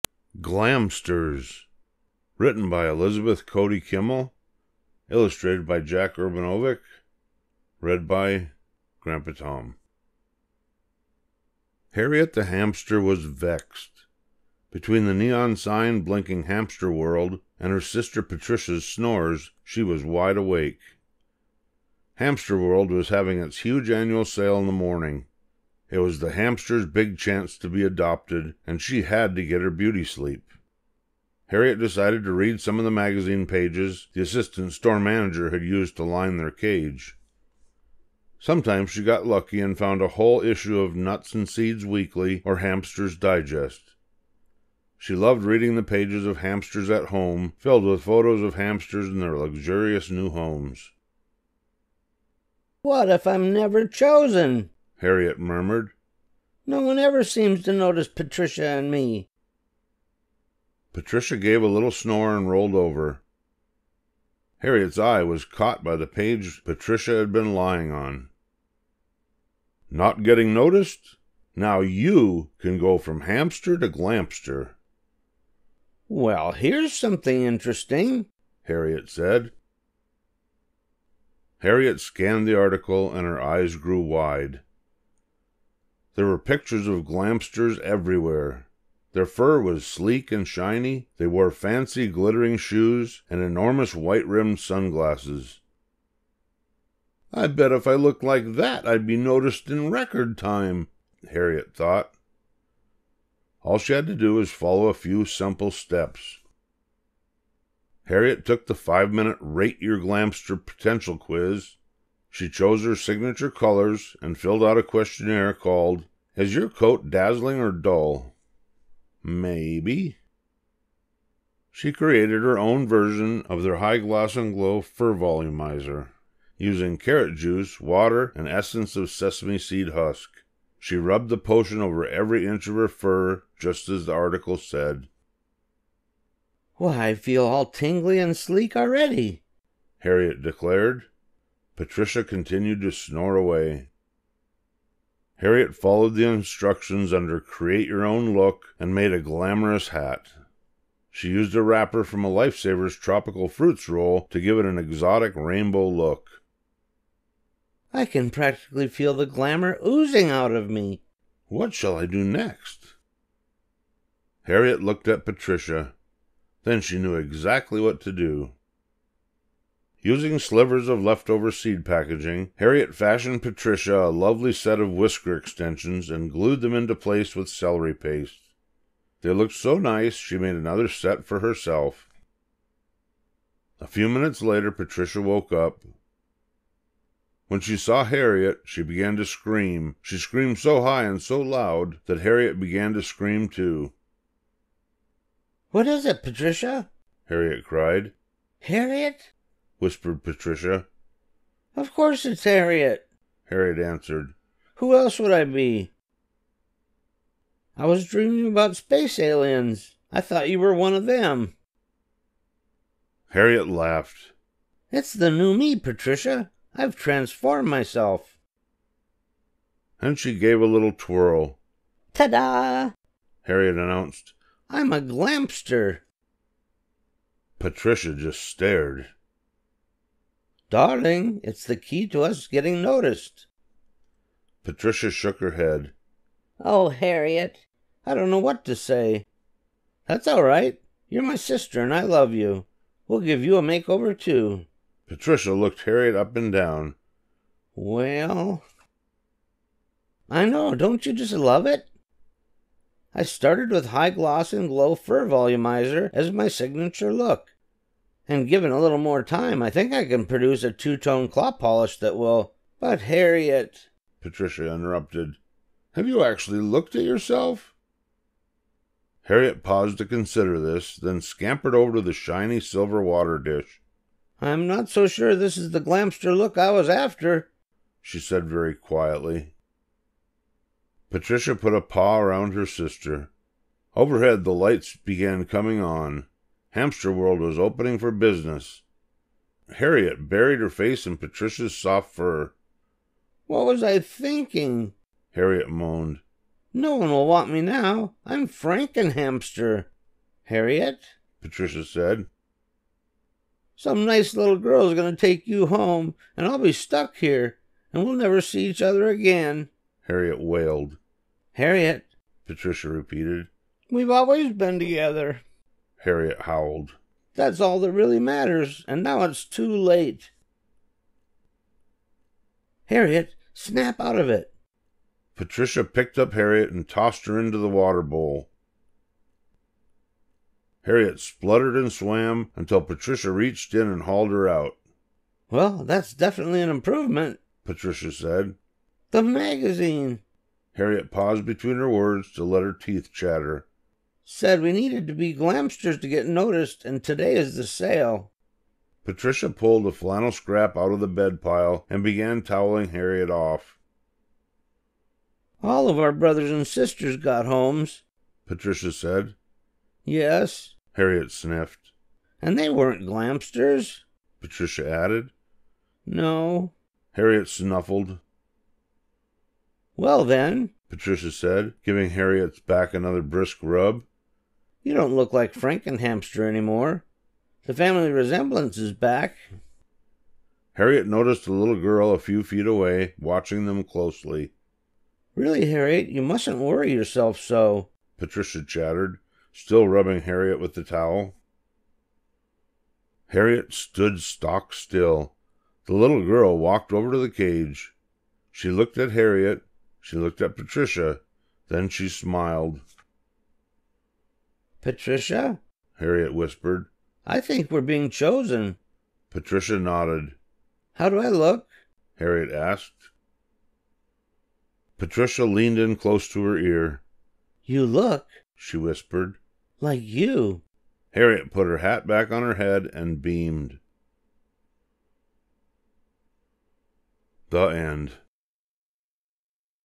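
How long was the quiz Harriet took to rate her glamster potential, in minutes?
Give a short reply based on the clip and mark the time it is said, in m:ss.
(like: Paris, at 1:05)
5, at 1:48.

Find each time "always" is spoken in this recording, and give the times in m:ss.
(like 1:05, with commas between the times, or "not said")
5:14.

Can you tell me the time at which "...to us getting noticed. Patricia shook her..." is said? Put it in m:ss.
3:52.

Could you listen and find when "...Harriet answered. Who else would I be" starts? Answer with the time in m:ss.
3:23.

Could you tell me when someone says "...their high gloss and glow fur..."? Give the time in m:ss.
2:03.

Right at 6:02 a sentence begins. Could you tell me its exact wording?
And they weren't glamsters, Patricia added.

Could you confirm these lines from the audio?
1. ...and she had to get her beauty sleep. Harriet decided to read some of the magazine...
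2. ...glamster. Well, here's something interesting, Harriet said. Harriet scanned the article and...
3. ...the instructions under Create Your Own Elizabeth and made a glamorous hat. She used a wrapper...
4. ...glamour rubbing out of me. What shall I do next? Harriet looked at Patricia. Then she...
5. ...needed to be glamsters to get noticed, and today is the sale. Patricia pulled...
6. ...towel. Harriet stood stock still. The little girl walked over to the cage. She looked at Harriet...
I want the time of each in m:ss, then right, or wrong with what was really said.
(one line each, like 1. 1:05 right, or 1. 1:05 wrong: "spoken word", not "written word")
1. 0:28 right
2. 1:13 right
3. 2:26 wrong: "Look", not "Elizabeth"
4. 2:39 wrong: "oozing", not "rubbing"
5. 5:44 right
6. 6:30 right.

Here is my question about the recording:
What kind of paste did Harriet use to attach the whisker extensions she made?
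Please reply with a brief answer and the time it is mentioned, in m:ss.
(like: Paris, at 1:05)
Celery paste, at 2:57.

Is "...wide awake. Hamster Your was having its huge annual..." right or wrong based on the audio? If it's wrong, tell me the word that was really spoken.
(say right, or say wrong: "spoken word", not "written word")
wrong: "World", not "Your".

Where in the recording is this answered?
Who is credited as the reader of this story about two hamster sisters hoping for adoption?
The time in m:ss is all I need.
0:08.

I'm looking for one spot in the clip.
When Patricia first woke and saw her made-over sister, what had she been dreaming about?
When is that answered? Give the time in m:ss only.
3:28.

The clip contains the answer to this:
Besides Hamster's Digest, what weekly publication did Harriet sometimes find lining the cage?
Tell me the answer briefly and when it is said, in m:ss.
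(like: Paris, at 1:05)
Nuts and Seeds Weekly, at 0:40.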